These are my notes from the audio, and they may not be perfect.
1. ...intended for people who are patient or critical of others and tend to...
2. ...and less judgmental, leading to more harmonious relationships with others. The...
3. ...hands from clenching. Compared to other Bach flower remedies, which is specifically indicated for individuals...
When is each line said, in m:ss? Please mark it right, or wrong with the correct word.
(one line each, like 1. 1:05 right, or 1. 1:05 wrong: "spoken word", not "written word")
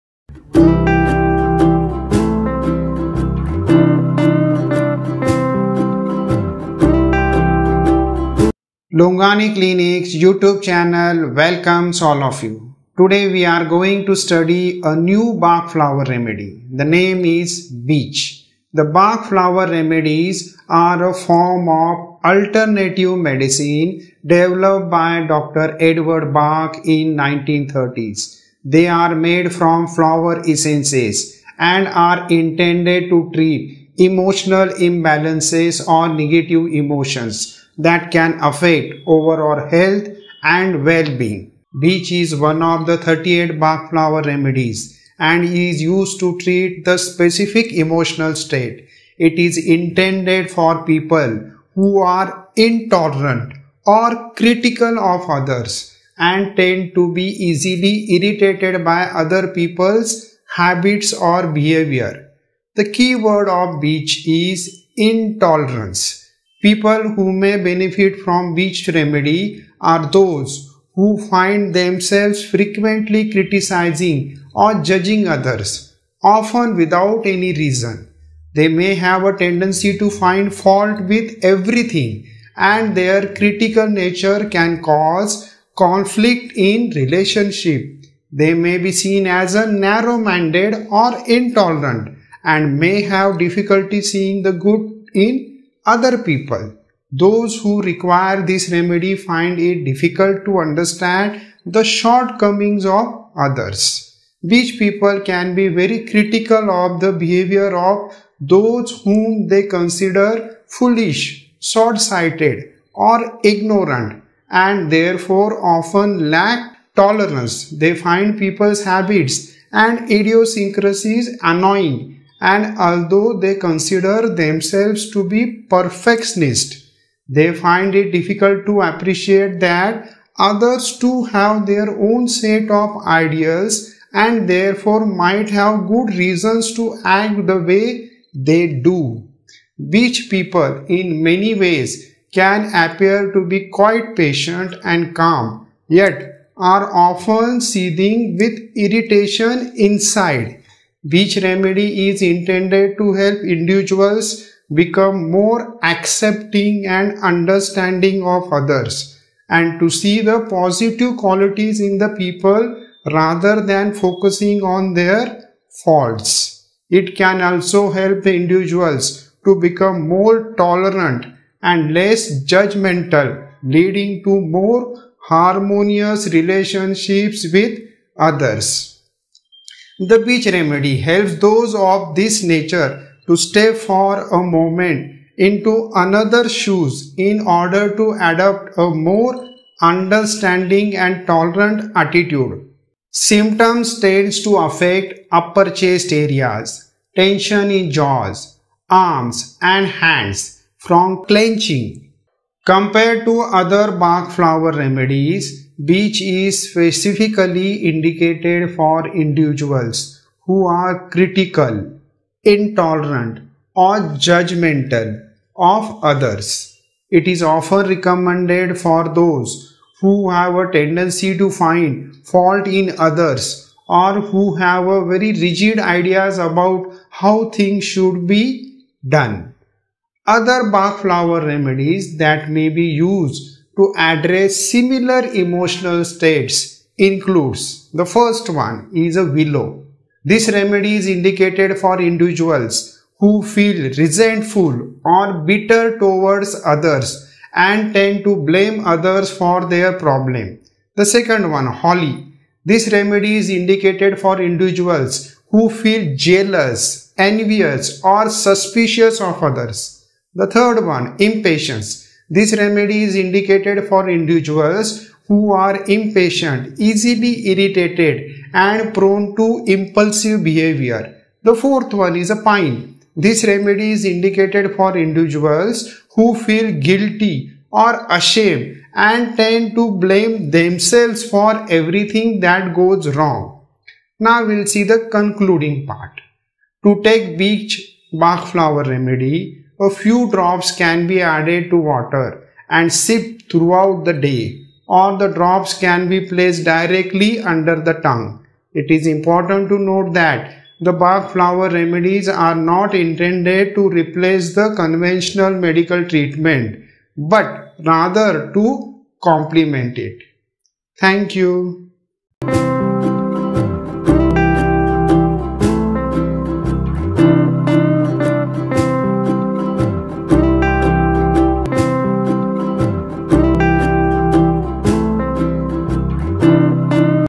1. 0:49 wrong: "intolerant", not "patient"
2. 2:51 right
3. 3:19 right.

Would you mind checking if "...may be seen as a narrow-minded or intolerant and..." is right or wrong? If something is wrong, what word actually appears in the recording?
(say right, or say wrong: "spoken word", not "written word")
right.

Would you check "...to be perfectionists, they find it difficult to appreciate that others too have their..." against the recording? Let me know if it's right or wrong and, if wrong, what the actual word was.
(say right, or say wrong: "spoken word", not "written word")
right.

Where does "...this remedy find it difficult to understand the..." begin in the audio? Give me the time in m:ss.
1:38.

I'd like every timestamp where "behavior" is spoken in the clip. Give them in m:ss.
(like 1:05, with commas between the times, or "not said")
1:01, 1:47, 4:30.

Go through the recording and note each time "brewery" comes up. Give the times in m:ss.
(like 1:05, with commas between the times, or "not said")
not said.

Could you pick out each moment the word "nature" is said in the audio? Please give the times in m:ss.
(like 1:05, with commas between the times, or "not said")
1:23, 3:02.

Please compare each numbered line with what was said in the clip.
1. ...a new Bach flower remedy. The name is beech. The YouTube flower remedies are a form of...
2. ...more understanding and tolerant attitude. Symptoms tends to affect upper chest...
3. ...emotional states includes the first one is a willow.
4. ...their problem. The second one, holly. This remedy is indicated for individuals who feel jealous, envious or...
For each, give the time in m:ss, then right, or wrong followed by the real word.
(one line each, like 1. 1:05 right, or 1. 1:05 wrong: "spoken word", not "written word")
1. 0:14 wrong: "Bach", not "YouTube"
2. 3:08 right
3. 3:55 right
4. 4:09 right.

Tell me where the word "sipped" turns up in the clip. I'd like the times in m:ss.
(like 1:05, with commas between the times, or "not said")
4:52.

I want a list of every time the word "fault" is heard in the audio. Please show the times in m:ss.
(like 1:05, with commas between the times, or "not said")
1:20, 2:45, 3:42.